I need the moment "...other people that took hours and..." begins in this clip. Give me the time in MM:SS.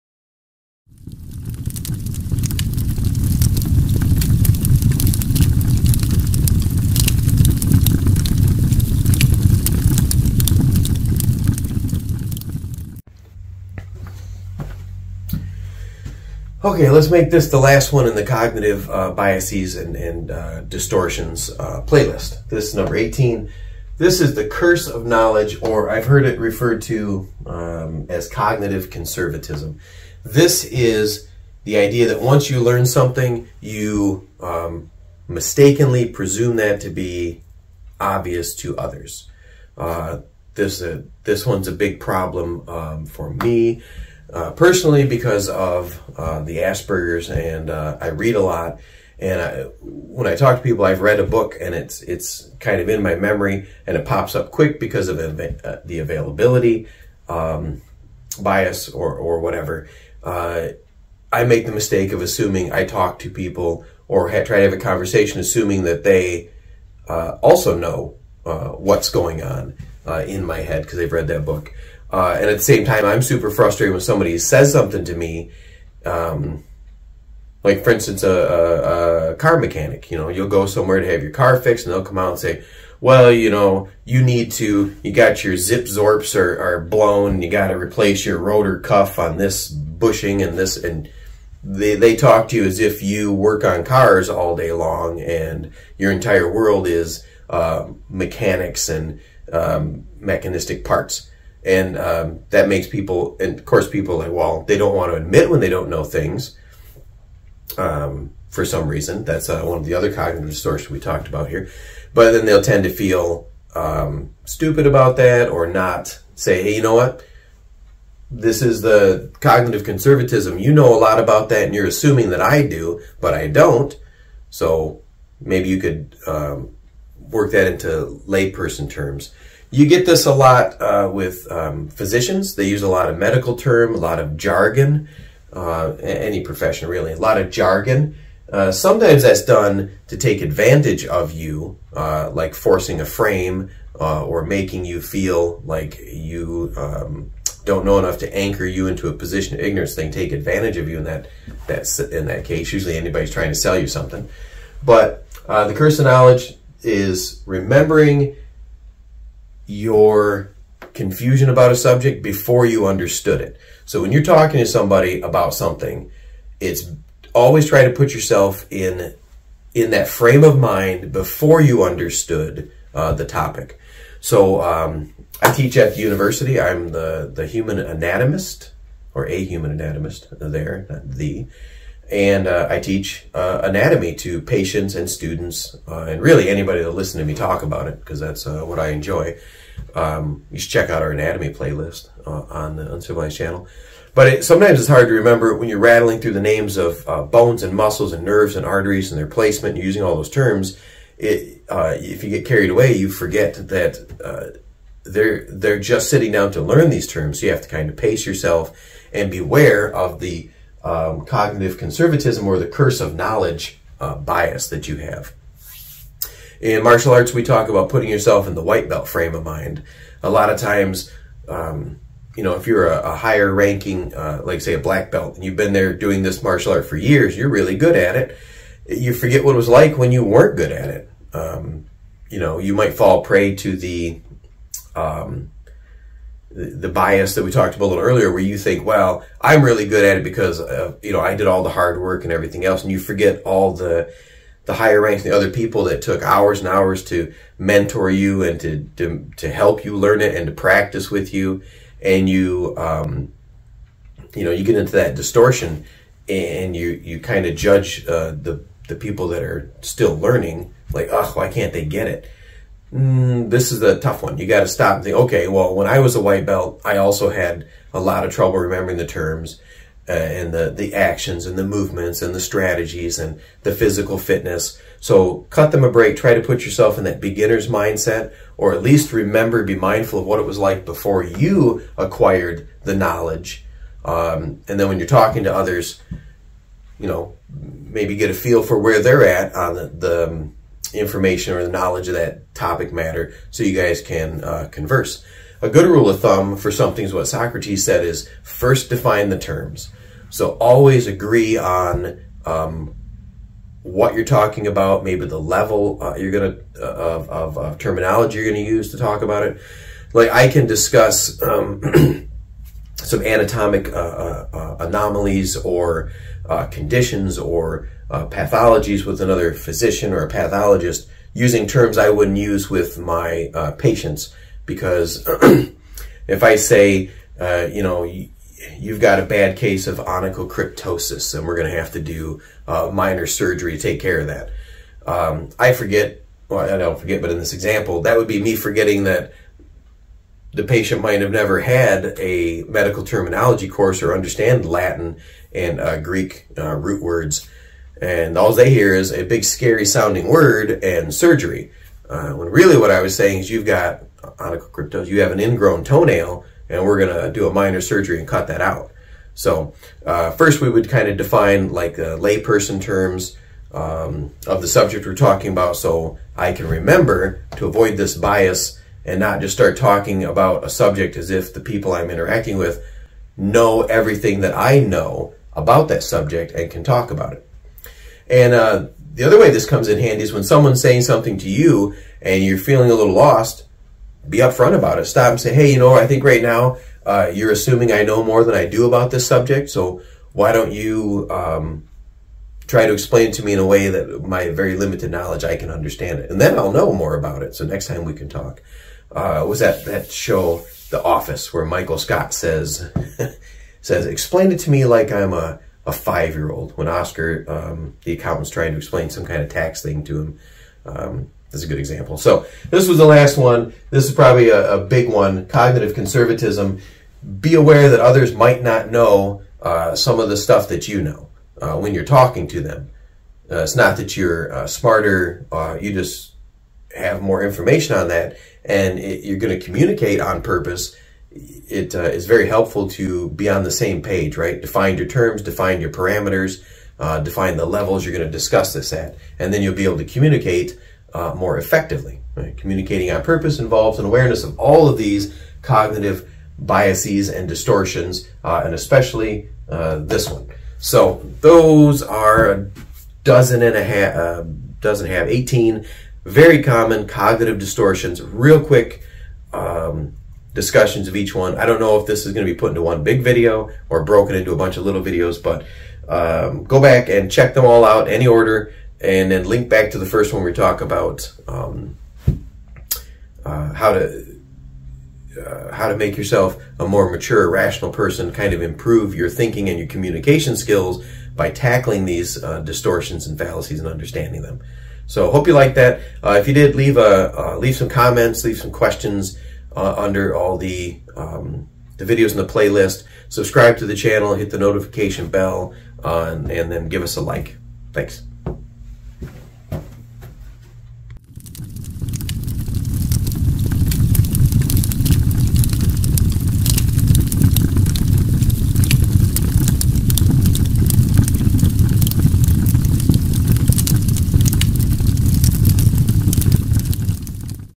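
04:05.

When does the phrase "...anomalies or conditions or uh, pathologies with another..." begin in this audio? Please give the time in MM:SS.
05:14.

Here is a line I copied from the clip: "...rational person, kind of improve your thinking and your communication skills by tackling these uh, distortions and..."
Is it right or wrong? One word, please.
right.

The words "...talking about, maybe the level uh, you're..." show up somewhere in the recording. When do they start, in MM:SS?
05:04.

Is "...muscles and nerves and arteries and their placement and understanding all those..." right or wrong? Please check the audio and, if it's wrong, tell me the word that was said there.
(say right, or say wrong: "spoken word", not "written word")
wrong: "using", not "understanding".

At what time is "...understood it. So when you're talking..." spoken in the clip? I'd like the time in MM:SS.
02:42.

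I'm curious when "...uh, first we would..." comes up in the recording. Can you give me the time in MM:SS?
06:00.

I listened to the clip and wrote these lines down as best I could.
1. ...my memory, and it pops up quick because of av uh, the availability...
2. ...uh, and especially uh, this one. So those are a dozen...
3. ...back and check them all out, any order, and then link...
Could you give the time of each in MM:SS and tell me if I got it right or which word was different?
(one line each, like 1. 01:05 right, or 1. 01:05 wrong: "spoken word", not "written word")
1. 00:53 right
2. 07:28 right
3. 07:46 right.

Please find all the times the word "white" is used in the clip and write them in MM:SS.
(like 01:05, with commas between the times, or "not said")
03:38, 04:26.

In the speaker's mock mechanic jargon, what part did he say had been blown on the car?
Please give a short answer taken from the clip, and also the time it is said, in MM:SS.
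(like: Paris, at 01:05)
zip zorps, at 01:25.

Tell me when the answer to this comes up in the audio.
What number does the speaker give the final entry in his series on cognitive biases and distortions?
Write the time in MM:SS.
00:22.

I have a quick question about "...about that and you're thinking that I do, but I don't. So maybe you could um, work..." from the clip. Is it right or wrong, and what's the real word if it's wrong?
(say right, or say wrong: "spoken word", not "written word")
wrong: "assuming", not "thinking".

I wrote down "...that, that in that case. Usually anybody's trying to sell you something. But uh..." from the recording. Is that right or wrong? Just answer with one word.
right.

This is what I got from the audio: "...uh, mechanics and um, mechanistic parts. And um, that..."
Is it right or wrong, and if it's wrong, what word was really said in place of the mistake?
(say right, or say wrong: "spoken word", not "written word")
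right.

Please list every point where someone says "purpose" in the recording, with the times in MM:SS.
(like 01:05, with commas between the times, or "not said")
07:10, 07:23.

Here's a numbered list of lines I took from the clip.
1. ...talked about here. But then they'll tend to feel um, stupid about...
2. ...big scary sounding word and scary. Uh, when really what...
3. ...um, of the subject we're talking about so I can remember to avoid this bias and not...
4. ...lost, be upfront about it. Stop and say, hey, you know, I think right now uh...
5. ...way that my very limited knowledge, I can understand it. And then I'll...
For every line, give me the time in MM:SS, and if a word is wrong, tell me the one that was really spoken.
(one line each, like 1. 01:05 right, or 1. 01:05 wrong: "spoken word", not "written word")
1. 01:50 right
2. 05:49 wrong: "surgery", not "scary"
3. 06:03 right
4. 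06:23 right
5. 06:33 right.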